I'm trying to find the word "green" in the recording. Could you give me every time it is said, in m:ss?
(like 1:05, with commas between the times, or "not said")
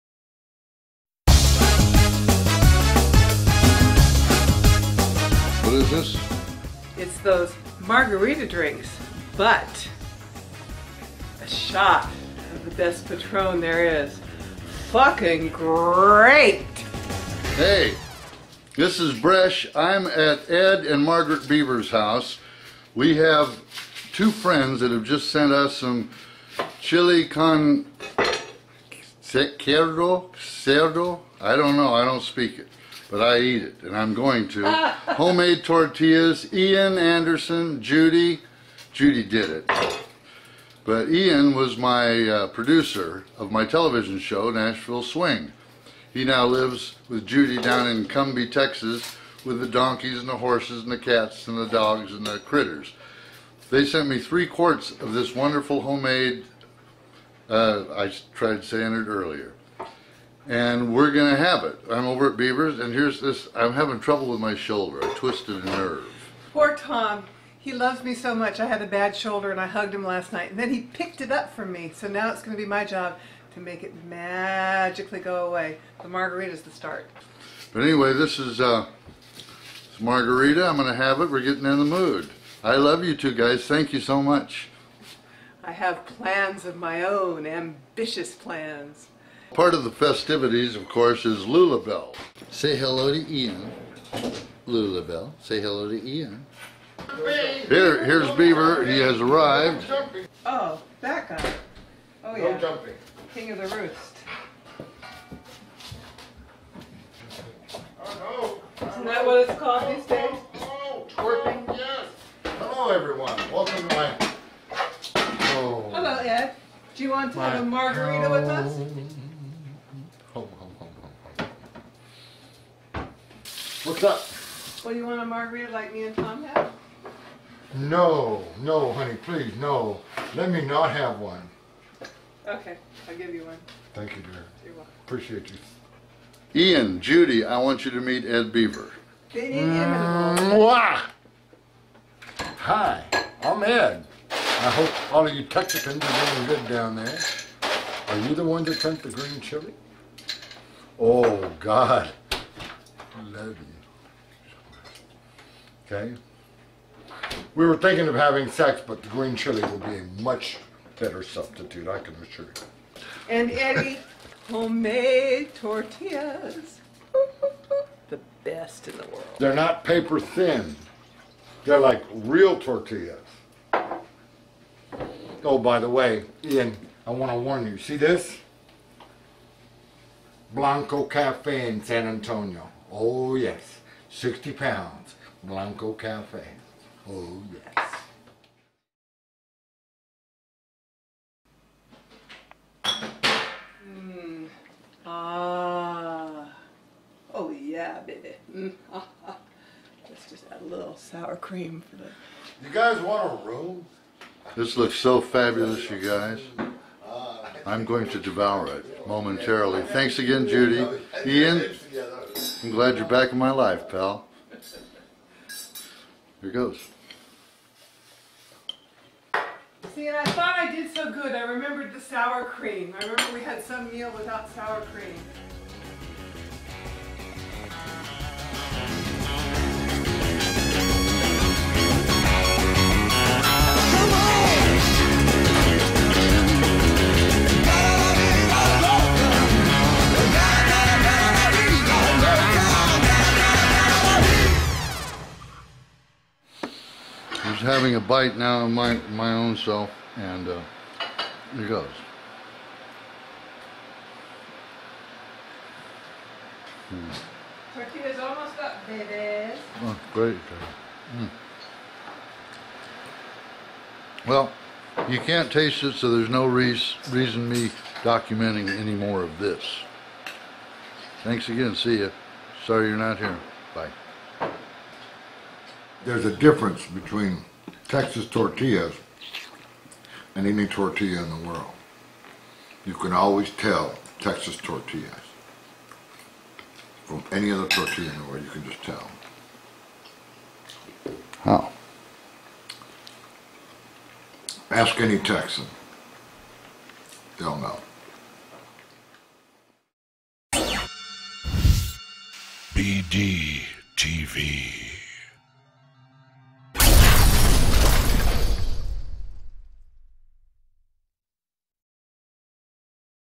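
2:29, 2:39.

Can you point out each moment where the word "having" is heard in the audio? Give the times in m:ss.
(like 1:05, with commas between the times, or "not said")
1:03, 2:38, 4:07.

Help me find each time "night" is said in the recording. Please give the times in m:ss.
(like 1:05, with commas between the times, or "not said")
1:10.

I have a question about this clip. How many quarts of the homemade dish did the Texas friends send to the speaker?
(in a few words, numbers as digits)
3.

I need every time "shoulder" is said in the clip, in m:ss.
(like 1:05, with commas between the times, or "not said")
1:04, 1:09.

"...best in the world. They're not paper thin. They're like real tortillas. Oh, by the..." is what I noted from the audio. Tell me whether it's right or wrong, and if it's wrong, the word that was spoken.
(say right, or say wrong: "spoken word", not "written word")
right.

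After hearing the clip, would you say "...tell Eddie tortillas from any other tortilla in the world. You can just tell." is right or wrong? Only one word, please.
wrong.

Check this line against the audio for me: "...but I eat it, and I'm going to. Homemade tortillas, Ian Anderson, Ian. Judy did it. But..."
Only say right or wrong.
wrong.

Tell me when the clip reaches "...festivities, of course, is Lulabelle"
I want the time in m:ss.
1:29.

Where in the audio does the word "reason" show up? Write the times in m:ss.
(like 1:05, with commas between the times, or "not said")
4:27.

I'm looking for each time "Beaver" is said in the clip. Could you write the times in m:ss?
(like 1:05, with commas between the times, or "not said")
0:21, 1:02, 1:38, 2:18.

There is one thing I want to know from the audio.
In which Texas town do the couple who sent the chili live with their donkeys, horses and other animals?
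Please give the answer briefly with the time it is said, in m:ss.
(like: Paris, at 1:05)
Cumby, Texas, at 0:48.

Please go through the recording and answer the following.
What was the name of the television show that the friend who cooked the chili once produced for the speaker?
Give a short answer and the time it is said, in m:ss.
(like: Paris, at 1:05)
Nashville Swing, at 0:44.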